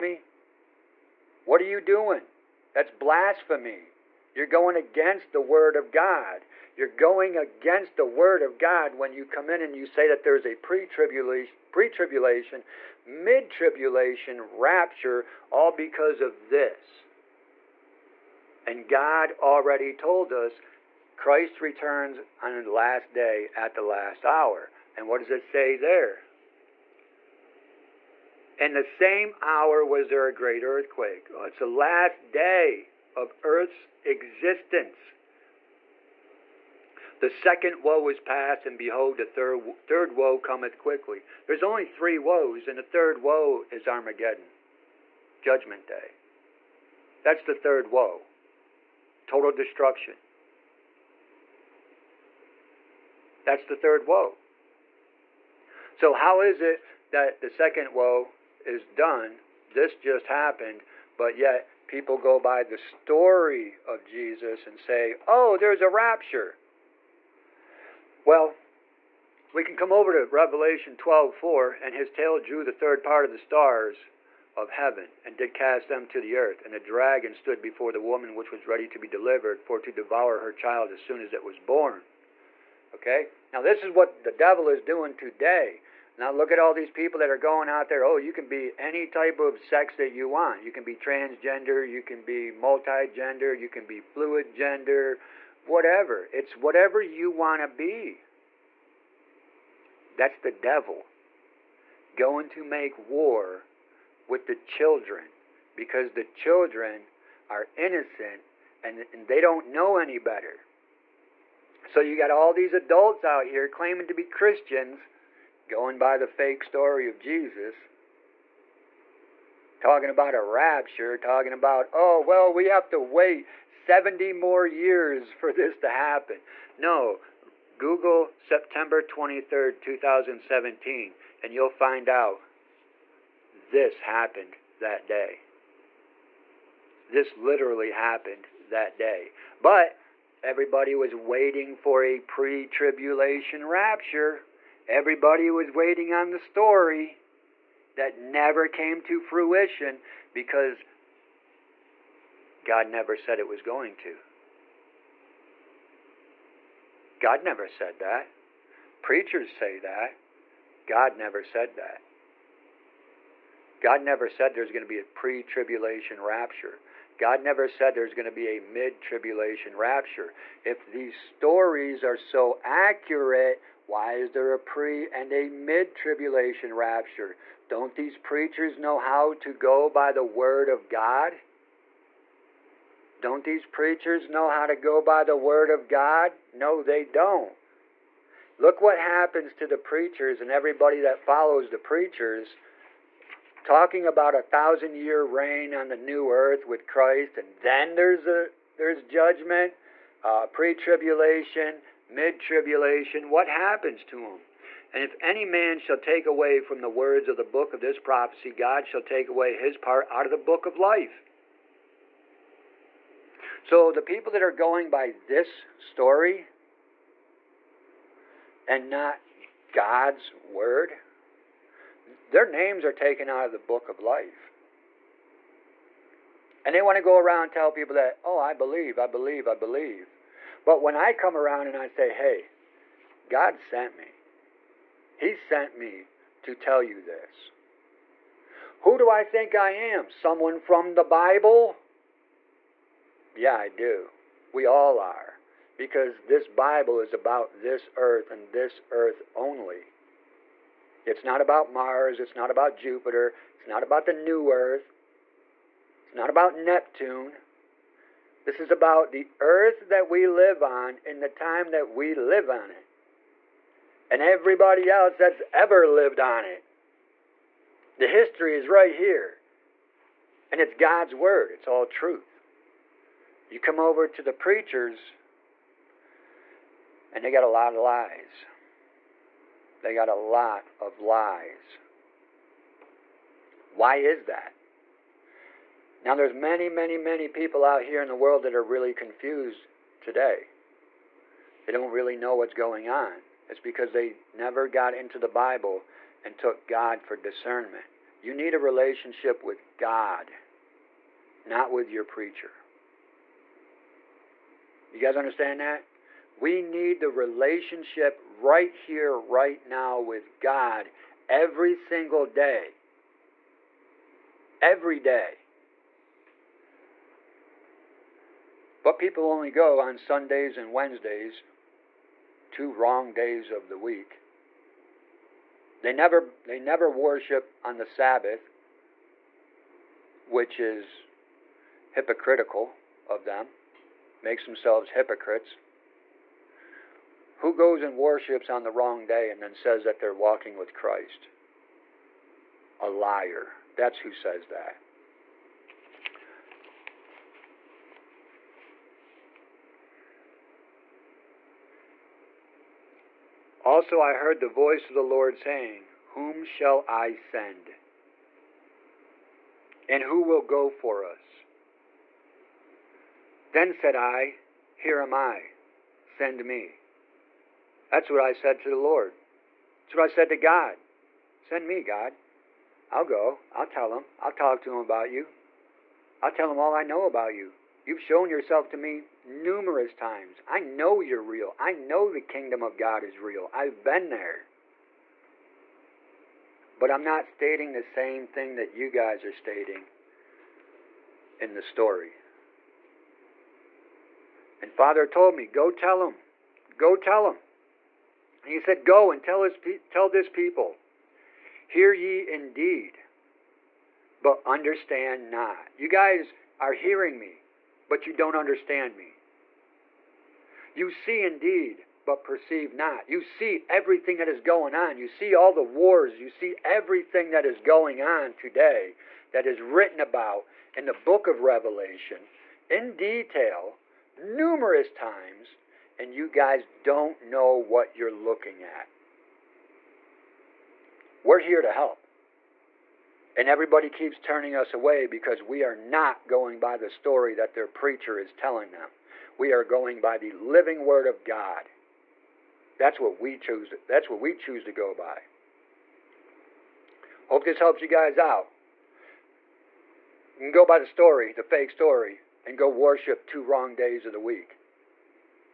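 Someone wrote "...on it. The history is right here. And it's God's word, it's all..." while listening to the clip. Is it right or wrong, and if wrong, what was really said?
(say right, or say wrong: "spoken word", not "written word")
right.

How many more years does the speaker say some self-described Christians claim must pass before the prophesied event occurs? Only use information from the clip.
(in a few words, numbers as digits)
70.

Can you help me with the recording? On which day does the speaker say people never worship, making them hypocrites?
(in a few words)
the Sabbath.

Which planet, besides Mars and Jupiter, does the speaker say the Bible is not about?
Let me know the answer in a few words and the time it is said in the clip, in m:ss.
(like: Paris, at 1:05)
Neptune, at 4:16.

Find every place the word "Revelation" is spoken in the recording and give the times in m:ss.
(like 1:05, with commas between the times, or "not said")
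1:10, 7:01.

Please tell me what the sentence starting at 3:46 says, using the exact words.
And they want to go around and tell people that, oh, I believe, I believe, I believe.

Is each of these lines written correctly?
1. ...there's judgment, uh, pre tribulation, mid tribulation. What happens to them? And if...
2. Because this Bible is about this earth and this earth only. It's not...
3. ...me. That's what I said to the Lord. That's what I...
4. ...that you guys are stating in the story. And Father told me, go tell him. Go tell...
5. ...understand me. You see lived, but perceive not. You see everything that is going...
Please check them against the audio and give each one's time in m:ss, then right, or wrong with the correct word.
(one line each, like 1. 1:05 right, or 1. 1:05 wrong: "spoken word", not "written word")
1. 3:18 right
2. 4:05 right
3. 6:06 right
4. 6:28 right
5. 6:48 wrong: "indeed", not "lived".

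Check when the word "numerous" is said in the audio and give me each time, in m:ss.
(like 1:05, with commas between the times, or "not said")
6:19, 7:04.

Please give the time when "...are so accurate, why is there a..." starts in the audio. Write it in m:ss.
2:52.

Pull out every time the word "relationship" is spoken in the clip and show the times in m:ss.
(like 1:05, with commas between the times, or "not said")
4:58, 5:07.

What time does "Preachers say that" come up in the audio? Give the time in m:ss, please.
2:38.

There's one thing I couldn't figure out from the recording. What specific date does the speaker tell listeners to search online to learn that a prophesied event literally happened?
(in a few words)
September 23, 2017.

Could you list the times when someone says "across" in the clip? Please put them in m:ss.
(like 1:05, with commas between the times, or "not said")
not said.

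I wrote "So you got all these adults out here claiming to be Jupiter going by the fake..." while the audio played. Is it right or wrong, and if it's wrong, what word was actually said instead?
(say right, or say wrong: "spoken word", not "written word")
wrong: "Christians", not "Jupiter".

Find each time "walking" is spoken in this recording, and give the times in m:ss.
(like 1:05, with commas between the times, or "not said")
5:40.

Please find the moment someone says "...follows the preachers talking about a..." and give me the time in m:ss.
3:11.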